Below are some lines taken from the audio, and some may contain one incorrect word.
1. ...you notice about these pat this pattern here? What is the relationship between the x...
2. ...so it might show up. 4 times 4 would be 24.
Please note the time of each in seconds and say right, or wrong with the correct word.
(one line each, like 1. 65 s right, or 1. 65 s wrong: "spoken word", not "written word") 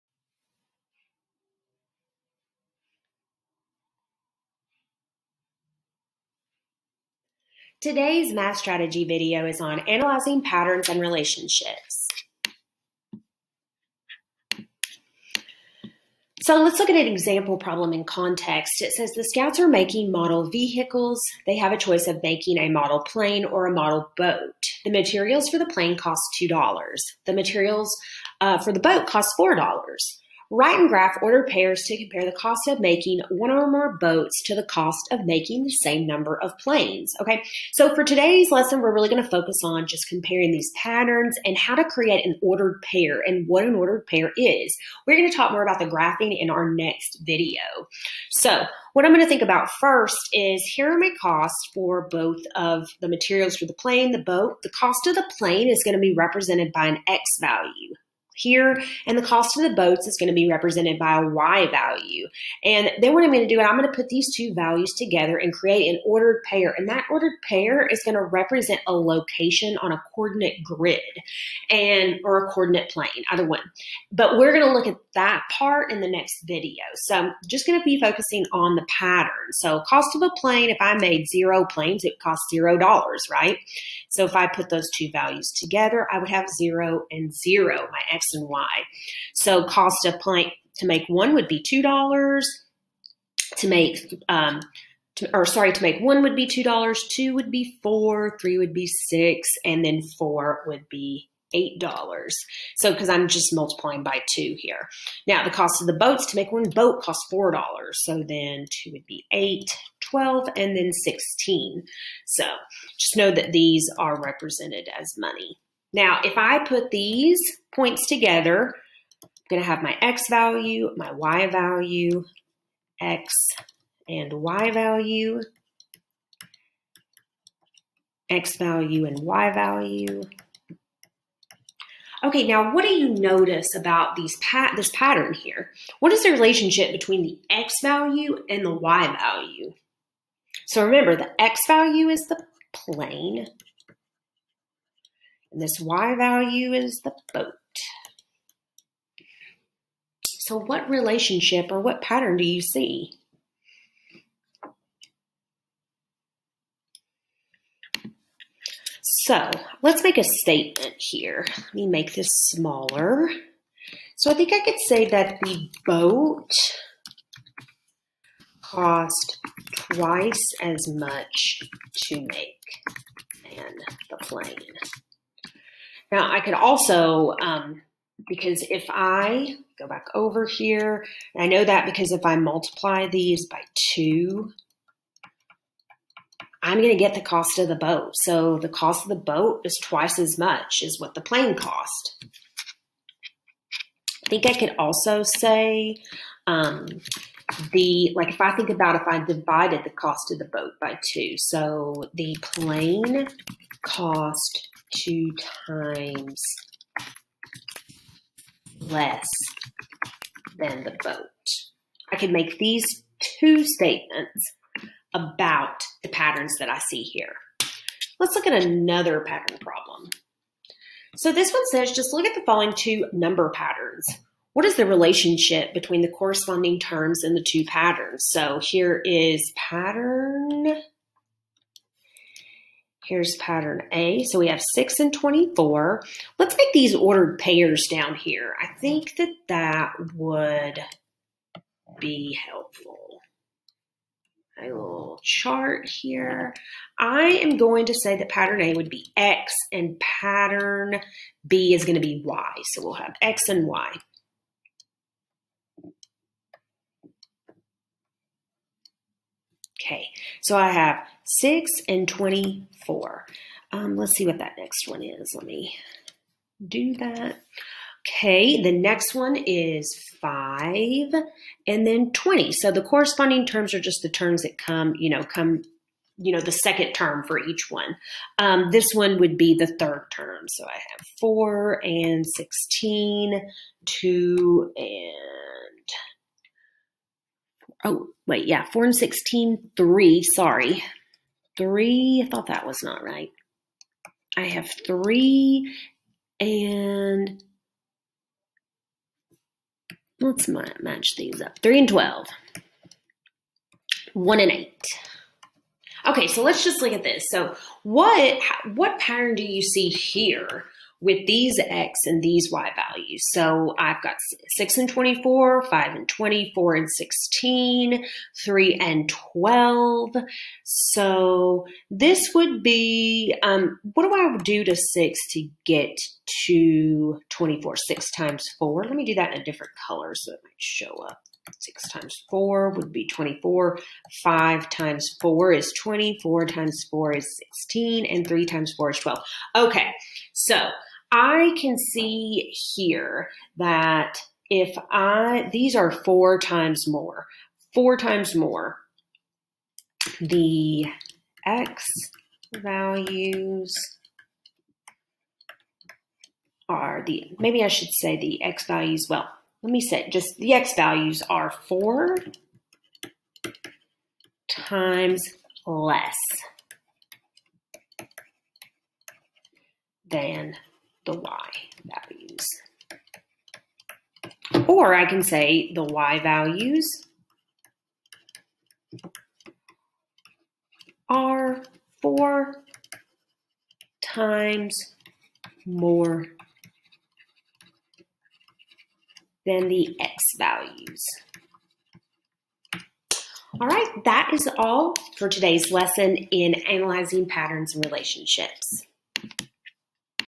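1. 132 s right
2. 330 s wrong: "6", not "4".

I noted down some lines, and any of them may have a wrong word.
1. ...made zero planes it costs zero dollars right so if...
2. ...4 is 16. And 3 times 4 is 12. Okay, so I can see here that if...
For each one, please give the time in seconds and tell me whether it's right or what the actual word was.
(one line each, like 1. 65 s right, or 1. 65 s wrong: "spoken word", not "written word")
1. 80 s right
2. 336 s right.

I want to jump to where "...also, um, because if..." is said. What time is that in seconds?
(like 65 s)
176 s.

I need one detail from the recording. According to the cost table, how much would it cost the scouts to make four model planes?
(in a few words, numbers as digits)
$8.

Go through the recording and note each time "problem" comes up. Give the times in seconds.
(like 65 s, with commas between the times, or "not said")
17 s, 219 s.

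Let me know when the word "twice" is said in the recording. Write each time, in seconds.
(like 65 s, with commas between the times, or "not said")
169 s, 189 s.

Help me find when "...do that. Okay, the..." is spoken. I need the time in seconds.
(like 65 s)
266 s.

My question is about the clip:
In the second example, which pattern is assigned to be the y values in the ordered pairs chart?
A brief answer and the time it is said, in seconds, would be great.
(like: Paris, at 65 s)
pattern B, at 249 s.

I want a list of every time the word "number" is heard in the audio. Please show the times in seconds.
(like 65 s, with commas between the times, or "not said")
36 s, 223 s.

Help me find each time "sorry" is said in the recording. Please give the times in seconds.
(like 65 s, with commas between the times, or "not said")
95 s, 290 s.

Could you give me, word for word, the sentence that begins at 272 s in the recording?
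So the corresponding terms are just the terms that come, you know, come you know, the second term for each one.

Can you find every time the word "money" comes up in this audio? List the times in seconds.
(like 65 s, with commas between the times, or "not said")
115 s.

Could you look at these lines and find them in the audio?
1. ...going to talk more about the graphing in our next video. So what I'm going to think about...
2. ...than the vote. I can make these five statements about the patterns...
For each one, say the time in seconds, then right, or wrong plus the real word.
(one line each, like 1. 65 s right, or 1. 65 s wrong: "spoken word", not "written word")
1. 45 s right
2. 210 s wrong: "two", not "five".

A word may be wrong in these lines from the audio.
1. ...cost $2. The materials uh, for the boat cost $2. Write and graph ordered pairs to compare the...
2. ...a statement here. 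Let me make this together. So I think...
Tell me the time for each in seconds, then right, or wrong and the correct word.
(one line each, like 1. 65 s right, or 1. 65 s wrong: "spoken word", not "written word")
1. 25 s wrong: "4", not "2"
2. 160 s wrong: "smaller", not "together".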